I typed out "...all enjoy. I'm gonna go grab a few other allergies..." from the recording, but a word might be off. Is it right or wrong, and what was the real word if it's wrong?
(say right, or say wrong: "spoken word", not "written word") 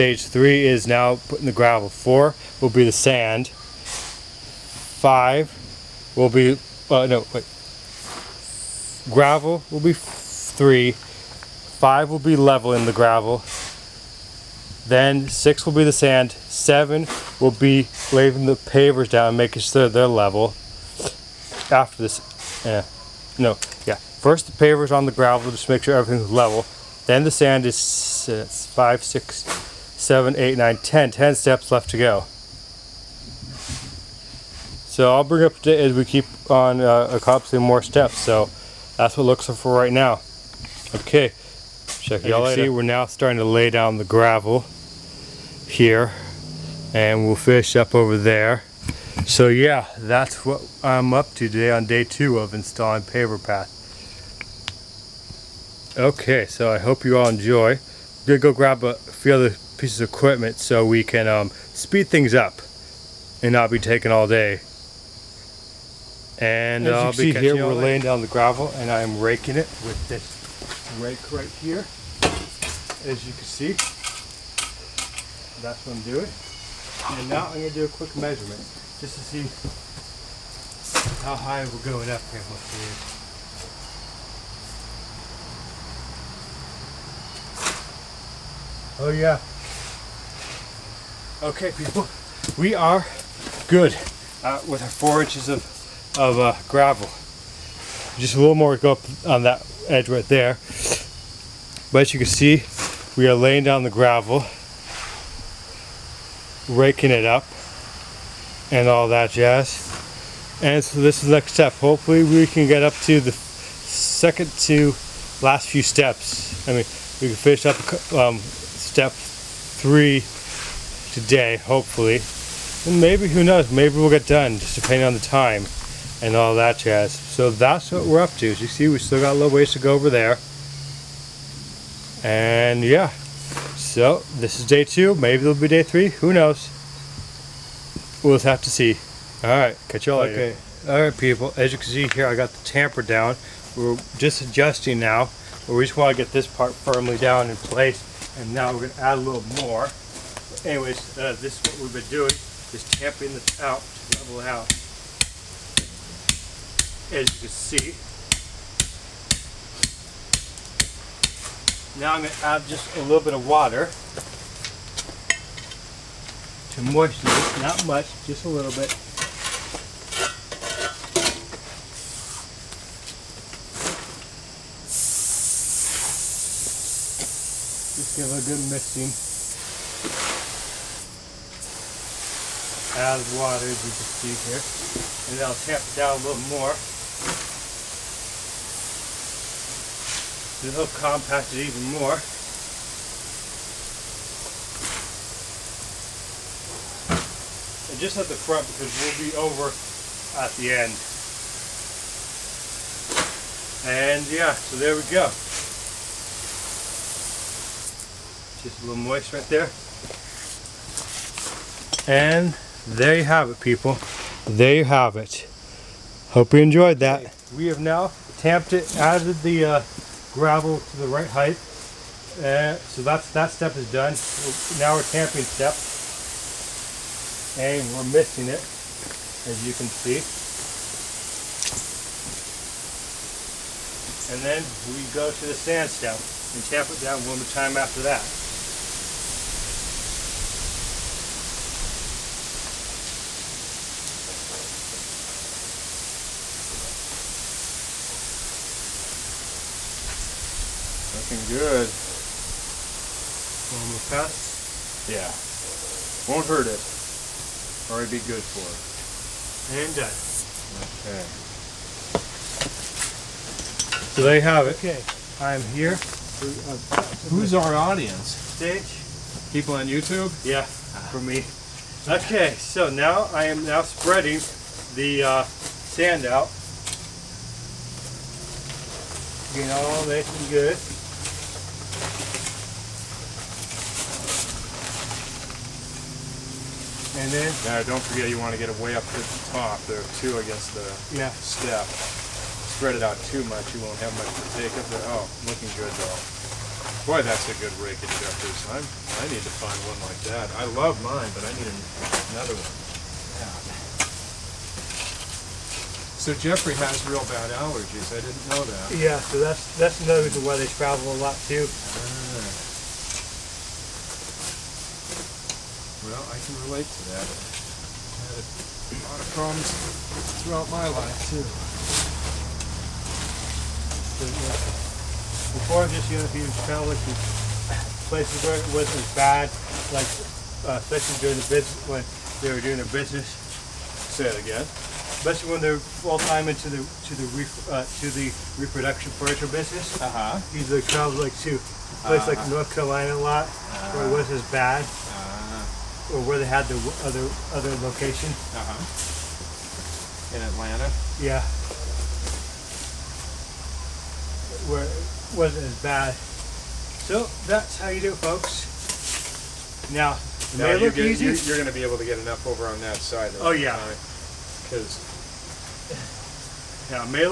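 wrong: "pieces", not "allergies".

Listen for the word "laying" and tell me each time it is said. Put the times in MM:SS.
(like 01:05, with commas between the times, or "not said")
00:18, 01:07, 01:43.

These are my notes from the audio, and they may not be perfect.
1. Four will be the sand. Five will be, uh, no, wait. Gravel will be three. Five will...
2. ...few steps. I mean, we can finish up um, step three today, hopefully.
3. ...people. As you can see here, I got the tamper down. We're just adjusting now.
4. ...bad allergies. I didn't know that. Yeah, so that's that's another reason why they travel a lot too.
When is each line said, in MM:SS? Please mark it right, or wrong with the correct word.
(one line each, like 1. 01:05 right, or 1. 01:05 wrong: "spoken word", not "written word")
1. 00:01 right
2. 01:55 right
3. 02:21 right
4. 05:07 right.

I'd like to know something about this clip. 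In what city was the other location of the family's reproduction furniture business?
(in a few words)
Atlanta.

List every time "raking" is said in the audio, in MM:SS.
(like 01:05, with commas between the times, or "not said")
01:09, 01:46.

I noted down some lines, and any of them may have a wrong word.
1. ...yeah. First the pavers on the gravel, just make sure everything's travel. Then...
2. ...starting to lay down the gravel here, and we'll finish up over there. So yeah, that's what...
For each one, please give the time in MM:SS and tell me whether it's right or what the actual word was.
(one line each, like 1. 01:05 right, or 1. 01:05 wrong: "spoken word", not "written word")
1. 00:23 wrong: "level", not "travel"
2. 00:43 right.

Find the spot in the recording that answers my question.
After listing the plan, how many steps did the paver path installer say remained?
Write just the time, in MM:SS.
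00:31.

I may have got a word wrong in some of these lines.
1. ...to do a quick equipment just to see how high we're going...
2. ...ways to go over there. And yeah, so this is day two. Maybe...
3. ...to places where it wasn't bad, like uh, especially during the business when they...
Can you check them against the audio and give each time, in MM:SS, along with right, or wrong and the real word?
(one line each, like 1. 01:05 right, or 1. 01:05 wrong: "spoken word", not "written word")
1. 01:17 wrong: "measurement", not "equipment"
2. 02:09 right
3. 05:26 right.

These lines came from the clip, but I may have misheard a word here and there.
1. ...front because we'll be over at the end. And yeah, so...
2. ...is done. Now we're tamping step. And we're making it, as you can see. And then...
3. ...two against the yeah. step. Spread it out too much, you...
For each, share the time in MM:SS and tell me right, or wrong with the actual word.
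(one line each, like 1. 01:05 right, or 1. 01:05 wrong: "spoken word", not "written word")
1. 03:18 right
2. 03:43 wrong: "missing", not "making"
3. 04:50 right.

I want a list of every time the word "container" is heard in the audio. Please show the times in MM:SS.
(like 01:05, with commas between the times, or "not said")
not said.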